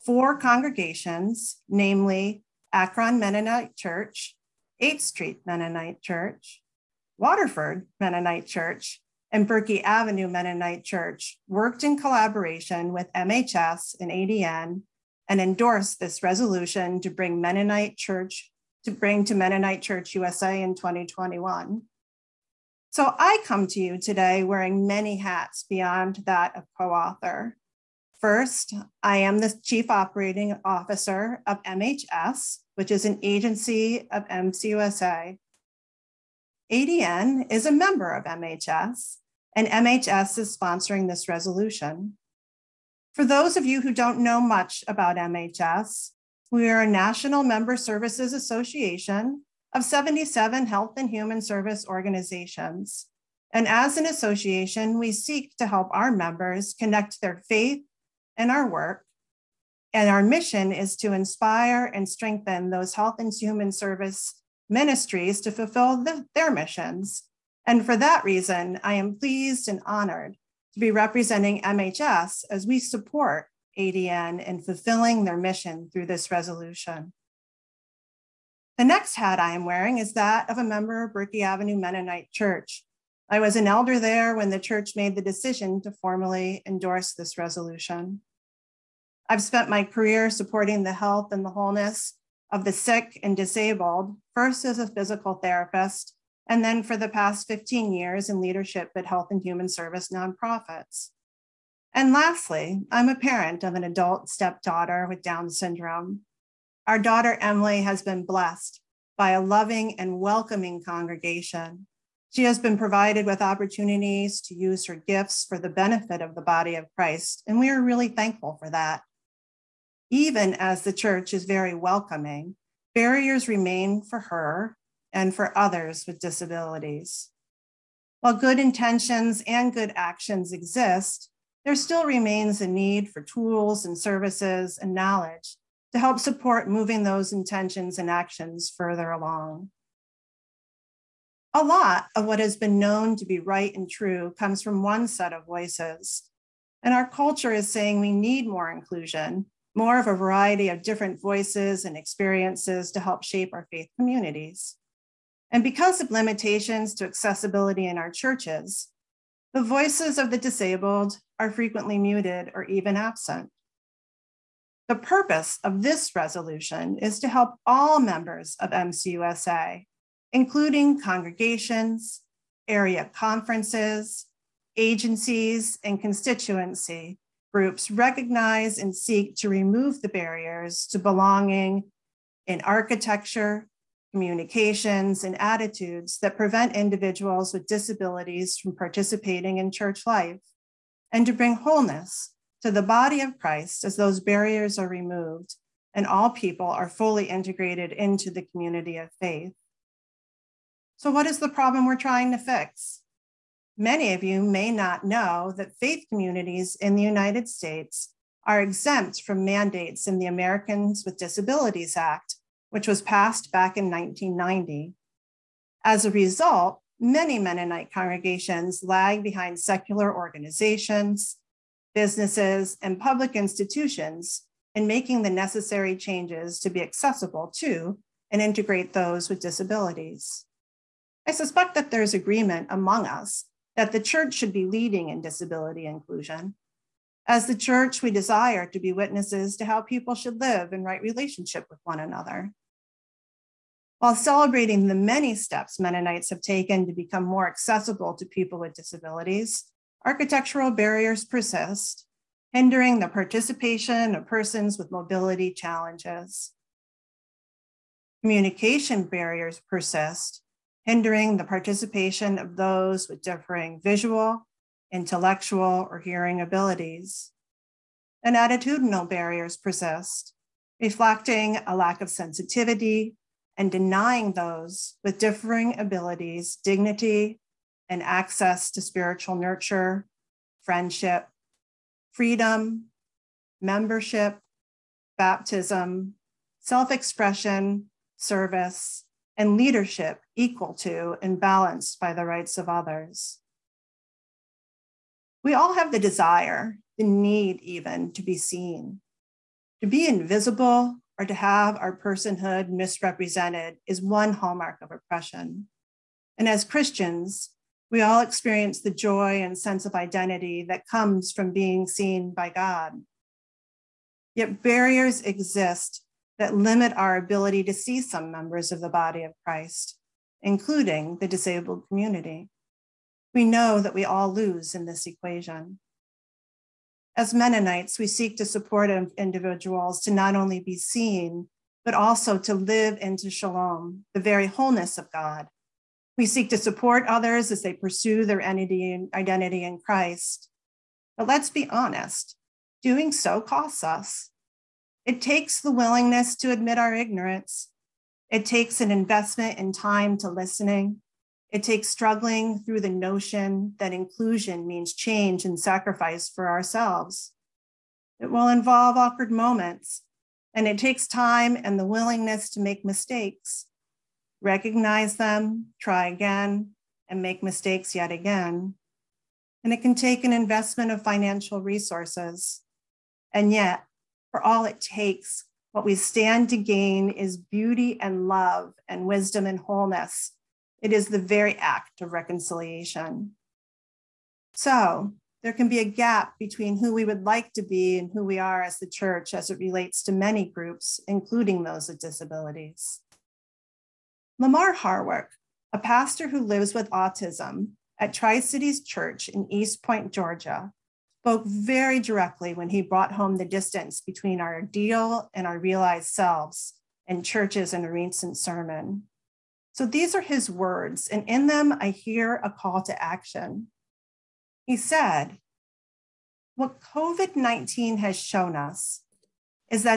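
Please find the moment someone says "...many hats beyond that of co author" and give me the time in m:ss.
0:24.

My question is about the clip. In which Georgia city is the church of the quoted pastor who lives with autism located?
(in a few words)
East Point.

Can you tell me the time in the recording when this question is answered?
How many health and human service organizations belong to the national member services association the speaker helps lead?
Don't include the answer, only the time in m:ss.
0:49.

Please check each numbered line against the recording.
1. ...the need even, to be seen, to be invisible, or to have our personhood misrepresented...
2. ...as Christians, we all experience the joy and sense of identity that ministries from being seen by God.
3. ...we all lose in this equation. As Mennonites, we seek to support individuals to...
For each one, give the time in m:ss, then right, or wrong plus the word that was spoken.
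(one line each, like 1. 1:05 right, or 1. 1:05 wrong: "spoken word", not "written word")
1. 4:56 right
2. 5:06 wrong: "comes", not "ministries"
3. 5:23 right.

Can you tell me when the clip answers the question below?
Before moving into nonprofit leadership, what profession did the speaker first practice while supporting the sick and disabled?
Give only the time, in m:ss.
1:34.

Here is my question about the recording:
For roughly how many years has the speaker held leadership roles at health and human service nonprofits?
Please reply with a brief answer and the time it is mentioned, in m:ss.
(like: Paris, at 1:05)
15 years, at 1:37.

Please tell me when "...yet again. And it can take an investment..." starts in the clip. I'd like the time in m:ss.
6:07.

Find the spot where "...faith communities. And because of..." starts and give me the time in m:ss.
2:33.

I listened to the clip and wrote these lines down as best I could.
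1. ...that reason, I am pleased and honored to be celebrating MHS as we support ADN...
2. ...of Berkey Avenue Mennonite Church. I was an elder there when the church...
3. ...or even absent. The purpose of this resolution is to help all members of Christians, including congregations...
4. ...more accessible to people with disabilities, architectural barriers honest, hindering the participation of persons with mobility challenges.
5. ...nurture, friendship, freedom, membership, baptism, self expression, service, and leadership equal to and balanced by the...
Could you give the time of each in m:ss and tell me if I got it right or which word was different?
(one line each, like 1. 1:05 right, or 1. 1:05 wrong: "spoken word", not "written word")
1. 1:07 wrong: "representing", not "celebrating"
2. 1:21 right
3. 2:42 wrong: "MCUSA", not "Christians"
4. 4:07 wrong: "persist", not "honest"
5. 4:39 right.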